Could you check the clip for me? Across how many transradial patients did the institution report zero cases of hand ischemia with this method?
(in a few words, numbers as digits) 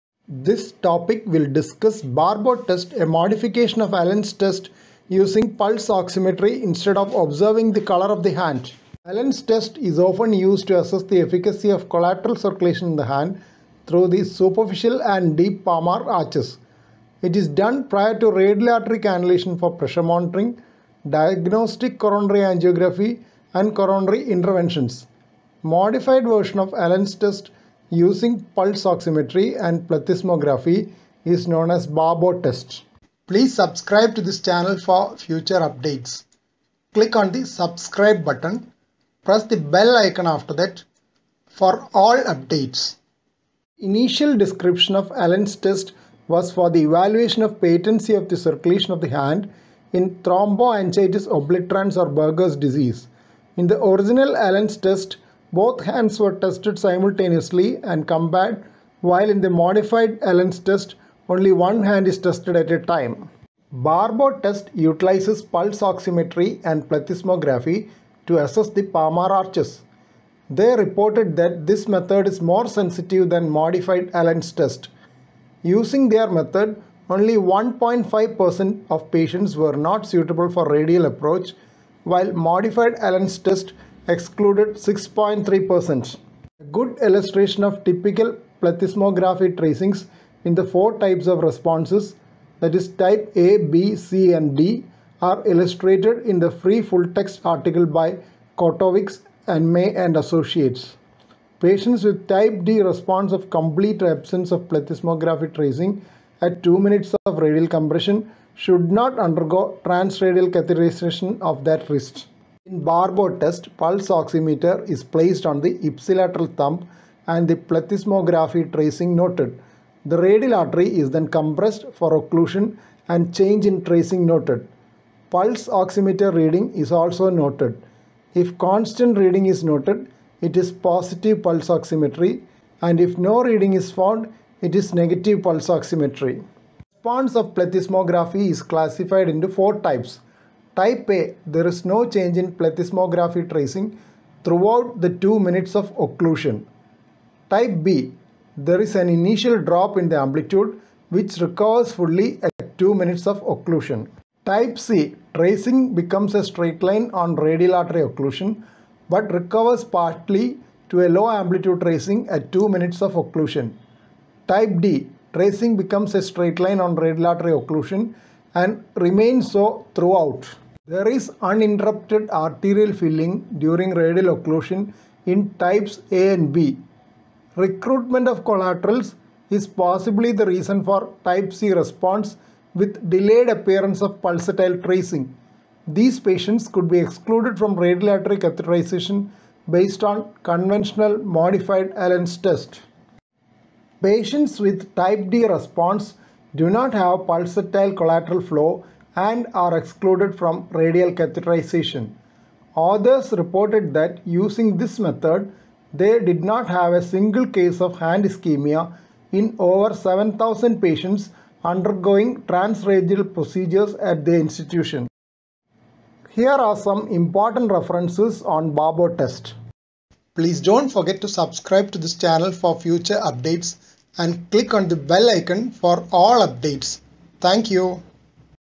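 7,000.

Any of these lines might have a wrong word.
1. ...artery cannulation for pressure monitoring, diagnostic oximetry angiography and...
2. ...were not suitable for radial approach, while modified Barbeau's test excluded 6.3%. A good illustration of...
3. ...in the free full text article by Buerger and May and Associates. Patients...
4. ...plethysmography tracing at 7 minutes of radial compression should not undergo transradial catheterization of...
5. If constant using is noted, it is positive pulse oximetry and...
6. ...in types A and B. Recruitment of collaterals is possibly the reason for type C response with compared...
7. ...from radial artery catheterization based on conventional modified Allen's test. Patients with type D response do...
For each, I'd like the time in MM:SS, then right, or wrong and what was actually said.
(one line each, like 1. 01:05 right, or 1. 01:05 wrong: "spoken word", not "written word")
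1. 00:18 wrong: "coronary", not "oximetry"
2. 01:19 wrong: "Allen", not "Barbeau"
3. 01:36 wrong: "Kotovics", not "Buerger"
4. 01:44 wrong: "2", not "7"
5. 02:08 wrong: "reading", not "using"
6. 02:55 wrong: "delayed", not "compared"
7. 03:07 right.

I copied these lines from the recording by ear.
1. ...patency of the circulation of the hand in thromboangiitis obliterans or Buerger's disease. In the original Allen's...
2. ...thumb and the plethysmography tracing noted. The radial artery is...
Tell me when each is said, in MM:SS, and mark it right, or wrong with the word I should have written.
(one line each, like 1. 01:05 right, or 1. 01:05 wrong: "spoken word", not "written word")
1. 00:47 right
2. 01:56 right.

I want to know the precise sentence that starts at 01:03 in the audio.
Barbeau test utilizes pulse oximetry and plethysmography to assess the palmar arches.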